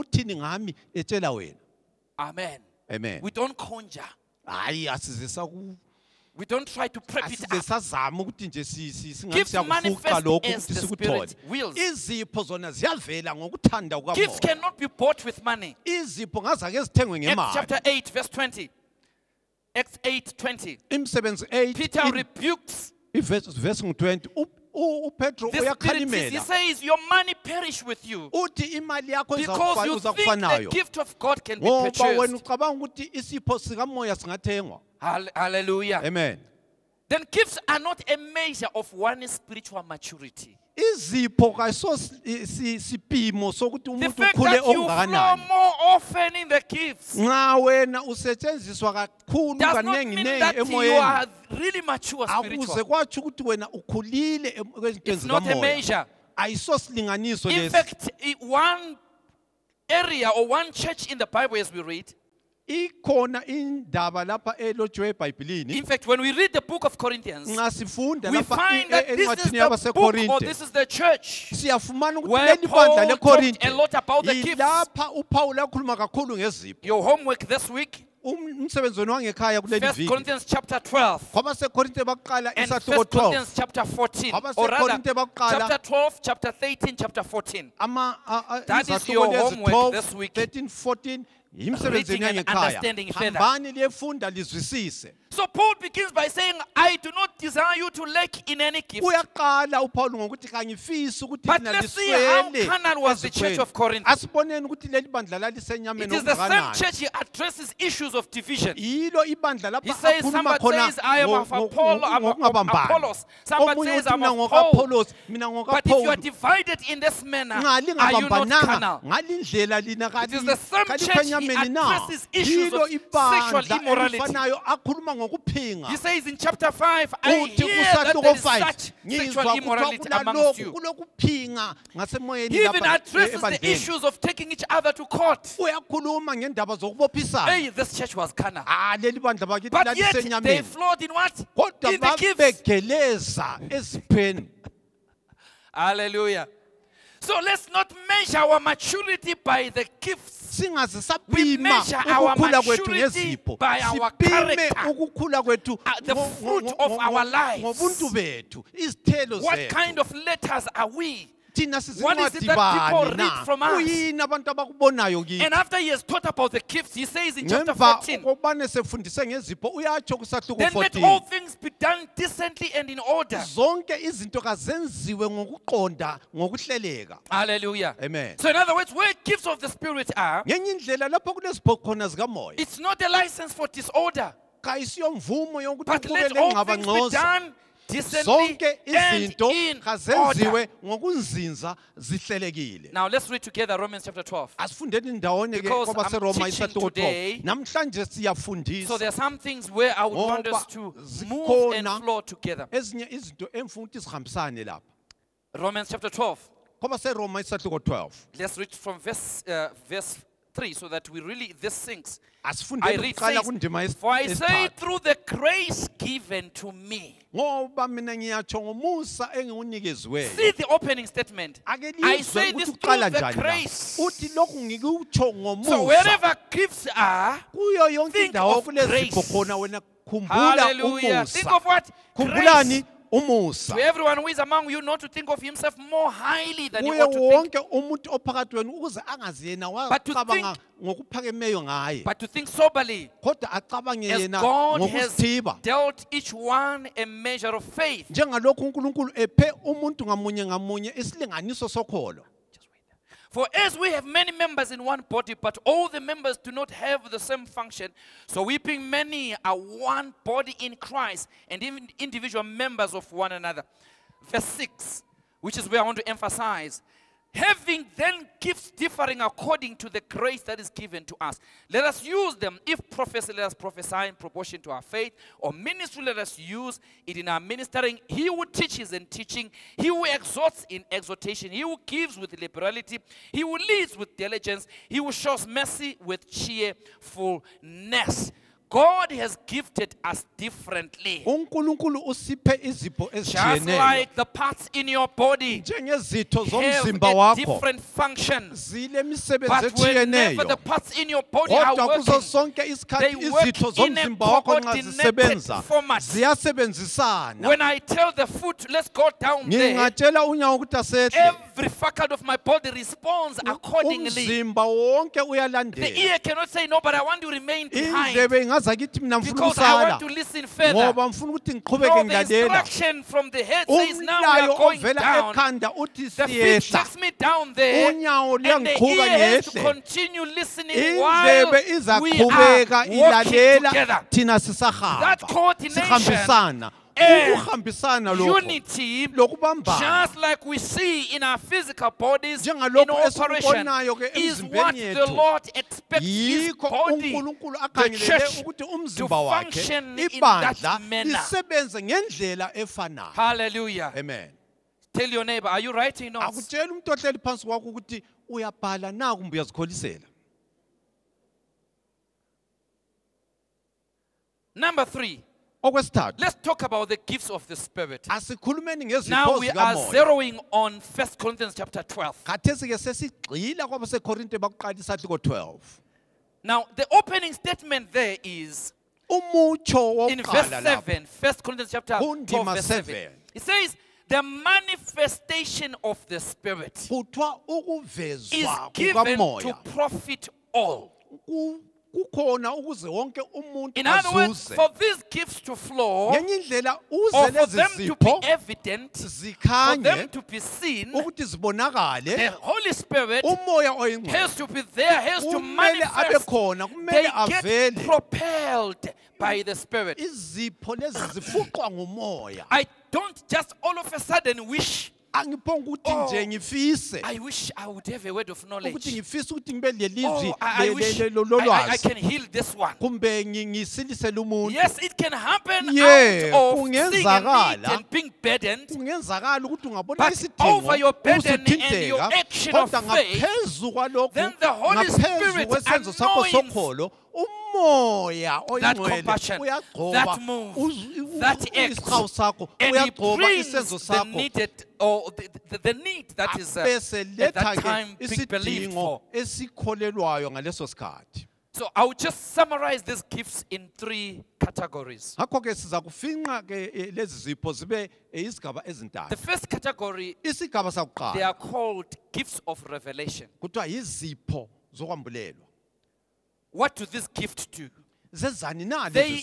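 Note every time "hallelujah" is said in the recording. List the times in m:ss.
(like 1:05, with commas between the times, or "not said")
0:35, 2:25, 2:57, 3:50, 5:53.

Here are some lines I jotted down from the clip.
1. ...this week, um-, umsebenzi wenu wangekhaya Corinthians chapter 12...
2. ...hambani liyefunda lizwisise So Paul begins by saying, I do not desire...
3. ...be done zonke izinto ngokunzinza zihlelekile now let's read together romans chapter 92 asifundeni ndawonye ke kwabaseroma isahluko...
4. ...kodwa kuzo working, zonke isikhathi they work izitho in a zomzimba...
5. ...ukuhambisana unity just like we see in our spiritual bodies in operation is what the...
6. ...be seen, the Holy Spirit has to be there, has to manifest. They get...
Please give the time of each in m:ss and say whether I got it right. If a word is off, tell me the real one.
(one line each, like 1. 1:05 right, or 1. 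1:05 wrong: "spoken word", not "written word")
1. 1:17 right
2. 1:33 right
3. 3:06 wrong: "12", not "92"
4. 5:01 wrong: "sonke", not "zonke"
5. 5:37 wrong: "physical", not "spiritual"
6. 6:40 right.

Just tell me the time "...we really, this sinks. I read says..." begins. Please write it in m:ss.
3:31.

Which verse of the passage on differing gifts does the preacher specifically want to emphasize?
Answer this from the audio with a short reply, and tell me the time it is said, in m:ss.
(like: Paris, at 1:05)
6, at 4:24.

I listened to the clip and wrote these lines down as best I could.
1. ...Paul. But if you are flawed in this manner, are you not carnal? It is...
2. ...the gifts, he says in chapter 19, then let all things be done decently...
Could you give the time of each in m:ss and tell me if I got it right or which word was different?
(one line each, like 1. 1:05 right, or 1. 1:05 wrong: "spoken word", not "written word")
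1. 1:54 wrong: "divided", not "flawed"
2. 2:46 wrong: "14", not "19".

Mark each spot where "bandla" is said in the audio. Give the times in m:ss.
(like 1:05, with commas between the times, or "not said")
1:12, 2:19.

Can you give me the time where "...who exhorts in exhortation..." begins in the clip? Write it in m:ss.
4:39.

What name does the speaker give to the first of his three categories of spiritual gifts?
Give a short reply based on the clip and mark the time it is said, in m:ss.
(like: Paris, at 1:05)
gifts of revelation, at 7:42.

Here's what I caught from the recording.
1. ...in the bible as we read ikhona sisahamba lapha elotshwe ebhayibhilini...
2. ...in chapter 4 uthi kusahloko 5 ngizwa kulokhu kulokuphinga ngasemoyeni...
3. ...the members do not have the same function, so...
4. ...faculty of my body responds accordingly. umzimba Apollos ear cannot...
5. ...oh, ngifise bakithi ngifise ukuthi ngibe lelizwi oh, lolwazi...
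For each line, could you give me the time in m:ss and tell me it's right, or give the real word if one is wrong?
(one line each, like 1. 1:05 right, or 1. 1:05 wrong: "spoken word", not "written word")
1. 1:01 wrong: "indaba", not "sisahamba"
2. 2:06 wrong: "5", not "4"
3. 4:15 right
4. 5:11 wrong: "The", not "Apollos"
5. 6:56 wrong: "ukuthi", not "bakithi".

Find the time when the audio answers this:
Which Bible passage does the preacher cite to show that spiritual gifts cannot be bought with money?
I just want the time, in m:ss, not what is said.
0:19.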